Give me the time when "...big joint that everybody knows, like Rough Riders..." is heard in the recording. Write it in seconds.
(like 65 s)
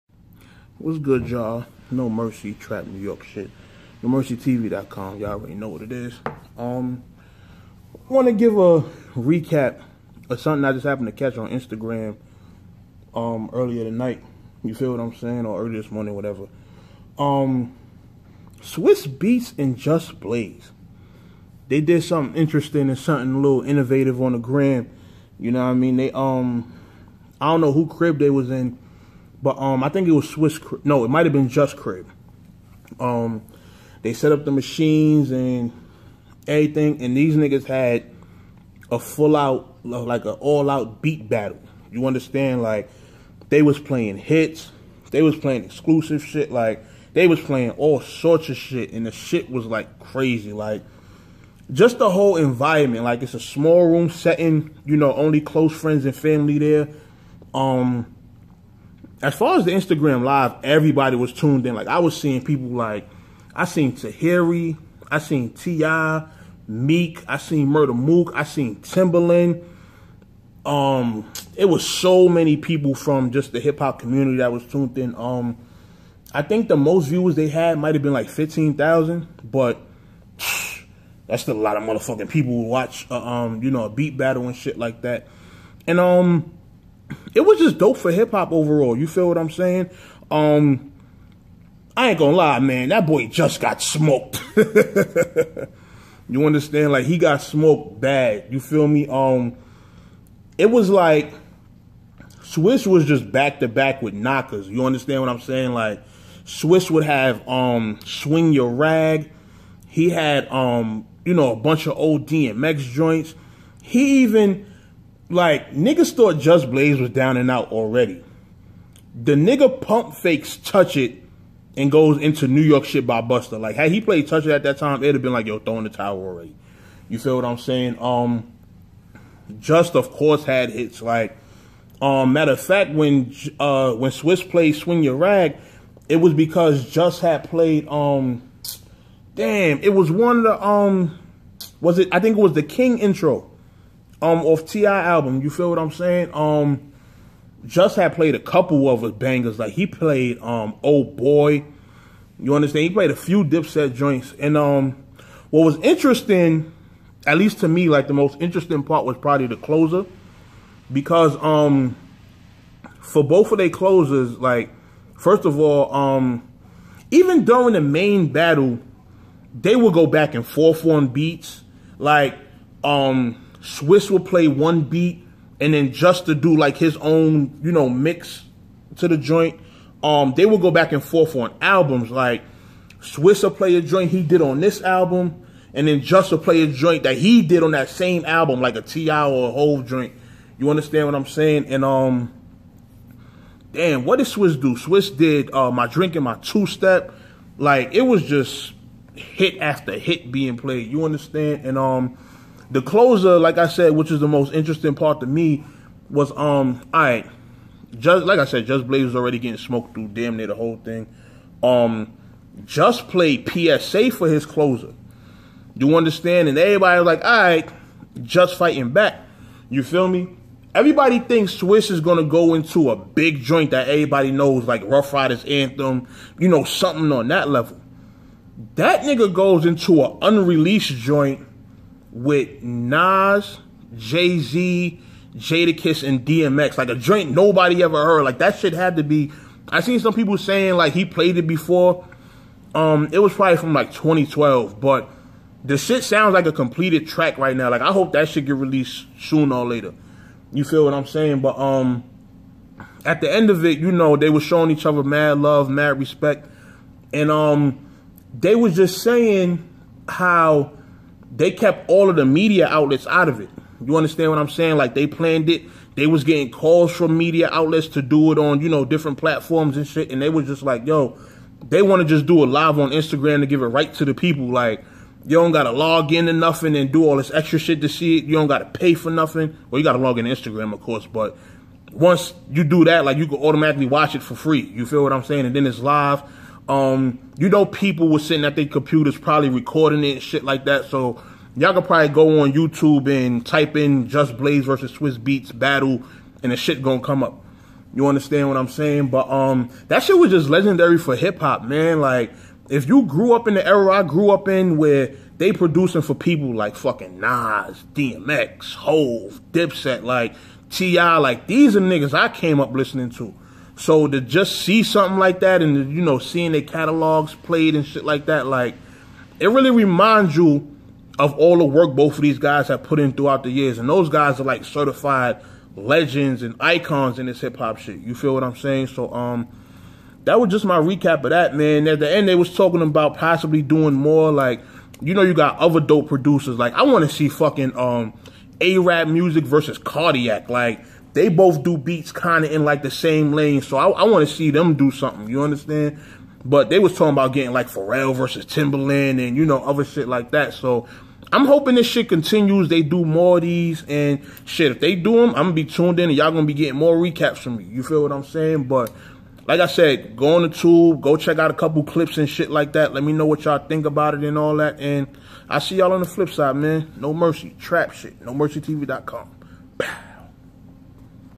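222 s.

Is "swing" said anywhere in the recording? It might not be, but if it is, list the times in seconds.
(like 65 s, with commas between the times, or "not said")
108 s, 134 s.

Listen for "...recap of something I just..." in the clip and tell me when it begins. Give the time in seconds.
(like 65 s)
9 s.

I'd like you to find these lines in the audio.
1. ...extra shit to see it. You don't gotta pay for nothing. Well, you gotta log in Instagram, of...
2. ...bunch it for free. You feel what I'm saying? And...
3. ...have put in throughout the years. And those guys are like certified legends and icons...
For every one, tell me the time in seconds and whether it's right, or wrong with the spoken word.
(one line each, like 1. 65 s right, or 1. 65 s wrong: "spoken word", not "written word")
1. 277 s right
2. 283 s wrong: "watch", not "bunch"
3. 322 s right.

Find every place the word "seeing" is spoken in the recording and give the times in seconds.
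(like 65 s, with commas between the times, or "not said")
62 s, 316 s.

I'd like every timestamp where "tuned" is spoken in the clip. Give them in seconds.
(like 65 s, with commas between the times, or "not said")
61 s, 74 s, 355 s.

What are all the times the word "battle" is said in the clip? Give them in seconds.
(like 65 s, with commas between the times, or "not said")
41 s, 84 s, 168 s, 295 s.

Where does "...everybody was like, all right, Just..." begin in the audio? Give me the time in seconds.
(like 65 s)
216 s.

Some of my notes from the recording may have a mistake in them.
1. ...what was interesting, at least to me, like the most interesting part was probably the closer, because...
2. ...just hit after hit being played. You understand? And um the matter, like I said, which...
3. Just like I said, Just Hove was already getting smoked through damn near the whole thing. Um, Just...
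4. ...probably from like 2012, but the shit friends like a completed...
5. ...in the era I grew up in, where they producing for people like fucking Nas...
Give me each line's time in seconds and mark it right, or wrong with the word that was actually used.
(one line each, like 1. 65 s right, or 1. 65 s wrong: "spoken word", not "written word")
1. 155 s right
2. 198 s wrong: "closer", not "matter"
3. 207 s wrong: "Blaze", not "Hove"
4. 243 s wrong: "sounds", not "friends"
5. 303 s right.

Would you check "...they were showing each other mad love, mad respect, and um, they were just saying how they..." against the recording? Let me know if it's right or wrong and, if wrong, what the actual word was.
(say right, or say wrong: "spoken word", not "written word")
right.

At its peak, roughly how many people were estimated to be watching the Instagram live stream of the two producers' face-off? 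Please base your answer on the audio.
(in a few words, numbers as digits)
15,000.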